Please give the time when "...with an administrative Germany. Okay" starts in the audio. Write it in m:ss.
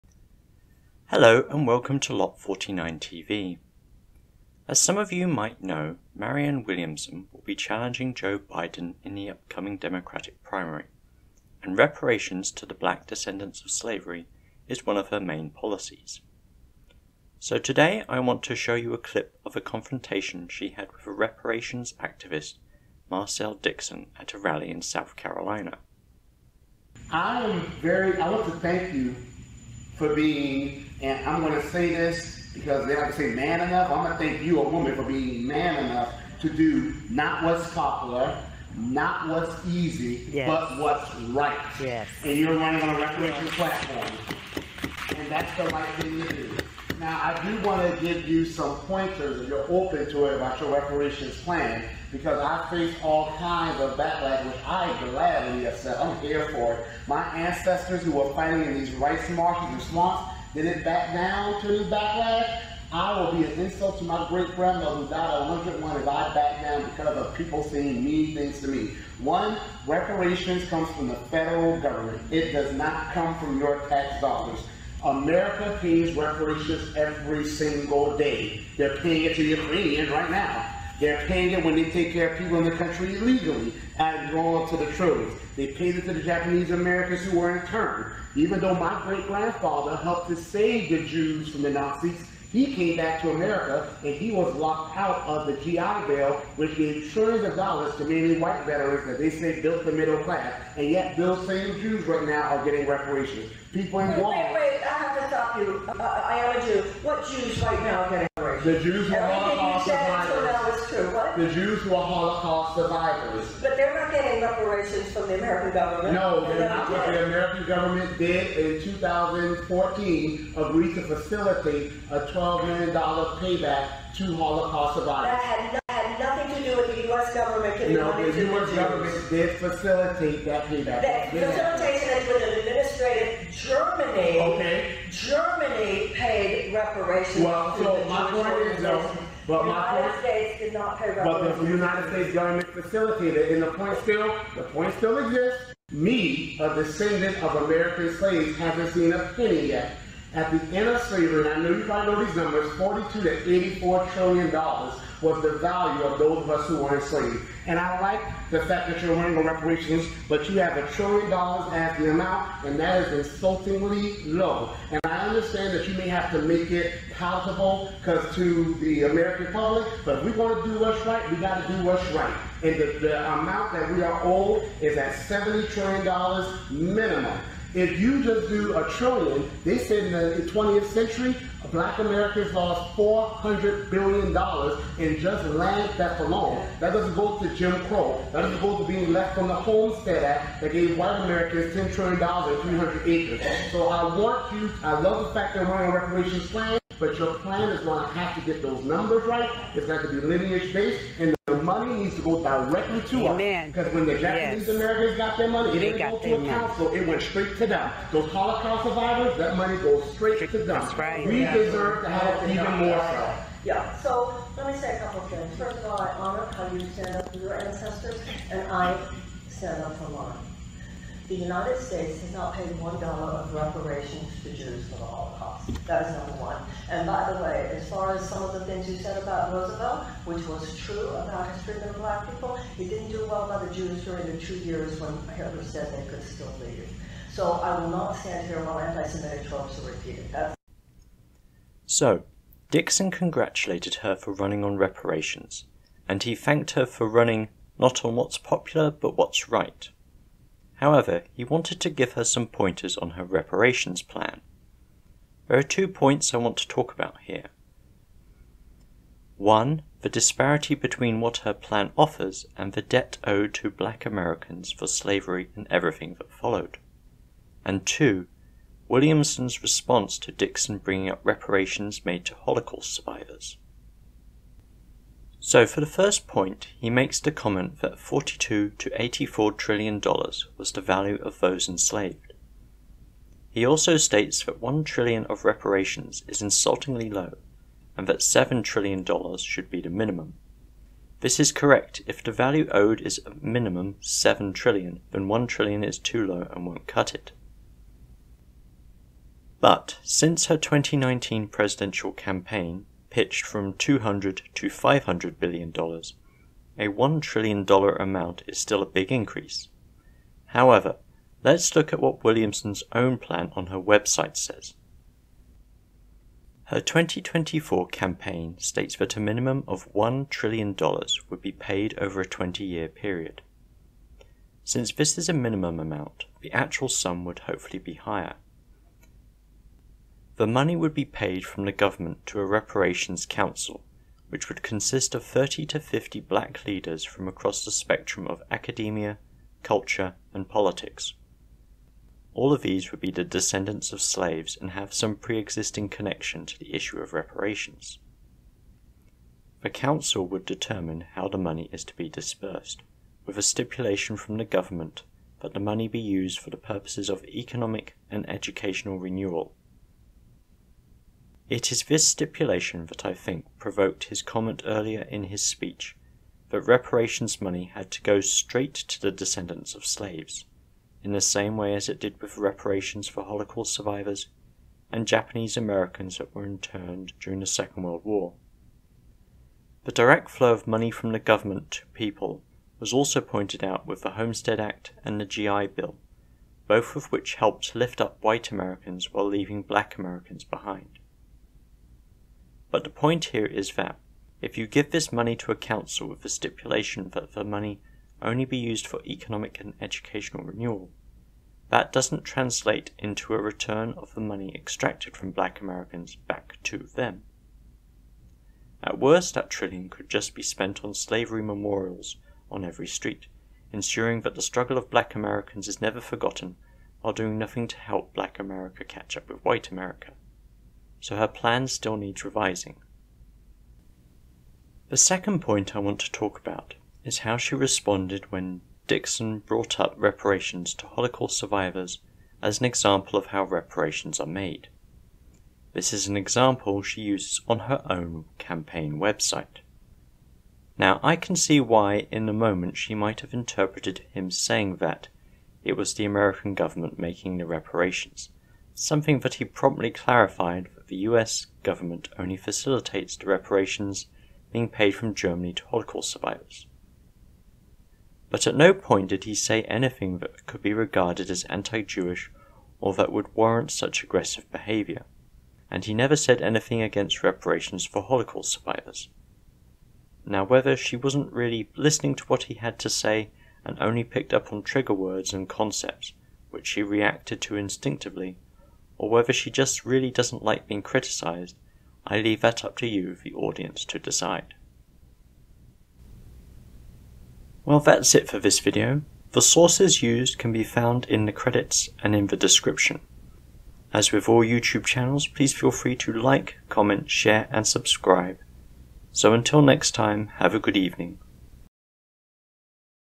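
2:12.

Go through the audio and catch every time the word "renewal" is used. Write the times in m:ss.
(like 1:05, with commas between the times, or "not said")
5:58, 6:40.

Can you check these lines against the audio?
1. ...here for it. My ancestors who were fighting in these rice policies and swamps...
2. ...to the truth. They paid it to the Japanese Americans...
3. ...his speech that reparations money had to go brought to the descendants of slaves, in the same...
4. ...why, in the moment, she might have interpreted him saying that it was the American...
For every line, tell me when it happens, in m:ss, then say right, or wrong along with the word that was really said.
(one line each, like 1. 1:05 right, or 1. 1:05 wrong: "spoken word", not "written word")
1. 0:56 wrong: "marshes", not "policies"
2. 1:24 right
3. 6:05 wrong: "straight", not "brought"
4. 7:21 right.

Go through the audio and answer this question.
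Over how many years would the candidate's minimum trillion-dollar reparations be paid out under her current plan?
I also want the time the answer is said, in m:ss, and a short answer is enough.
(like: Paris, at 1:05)
20, at 5:22.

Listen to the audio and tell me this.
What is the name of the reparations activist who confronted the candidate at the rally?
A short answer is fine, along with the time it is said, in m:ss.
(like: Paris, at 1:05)
Marcel Dixon, at 0:23.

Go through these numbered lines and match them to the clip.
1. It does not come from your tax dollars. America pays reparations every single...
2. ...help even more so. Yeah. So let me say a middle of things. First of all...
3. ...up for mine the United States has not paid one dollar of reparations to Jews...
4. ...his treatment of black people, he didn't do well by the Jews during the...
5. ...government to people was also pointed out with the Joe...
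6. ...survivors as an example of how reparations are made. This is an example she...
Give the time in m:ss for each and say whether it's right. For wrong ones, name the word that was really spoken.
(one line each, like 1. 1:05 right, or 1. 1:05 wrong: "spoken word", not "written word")
1. 1:12 right
2. 3:32 wrong: "couple", not "middle"
3. 3:39 right
4. 3:51 right
5. 6:21 wrong: "Homestead", not "Joe"
6. 7:11 right.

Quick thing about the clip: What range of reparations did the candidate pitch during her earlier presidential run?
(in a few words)
200 to 500 billion dollars.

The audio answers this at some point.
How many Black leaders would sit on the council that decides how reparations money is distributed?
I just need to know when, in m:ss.
5:35.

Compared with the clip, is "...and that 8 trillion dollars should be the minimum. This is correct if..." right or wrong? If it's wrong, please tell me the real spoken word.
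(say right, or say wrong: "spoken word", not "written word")
wrong: "7", not "8".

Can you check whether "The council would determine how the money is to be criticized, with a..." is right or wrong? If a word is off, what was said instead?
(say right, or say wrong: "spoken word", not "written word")
wrong: "dispersed", not "criticized".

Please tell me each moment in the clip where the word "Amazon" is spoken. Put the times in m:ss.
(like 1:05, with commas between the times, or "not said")
not said.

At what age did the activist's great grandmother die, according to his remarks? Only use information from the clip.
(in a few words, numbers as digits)
101.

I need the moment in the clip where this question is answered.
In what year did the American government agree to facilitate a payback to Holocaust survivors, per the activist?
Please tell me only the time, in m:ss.
1:58.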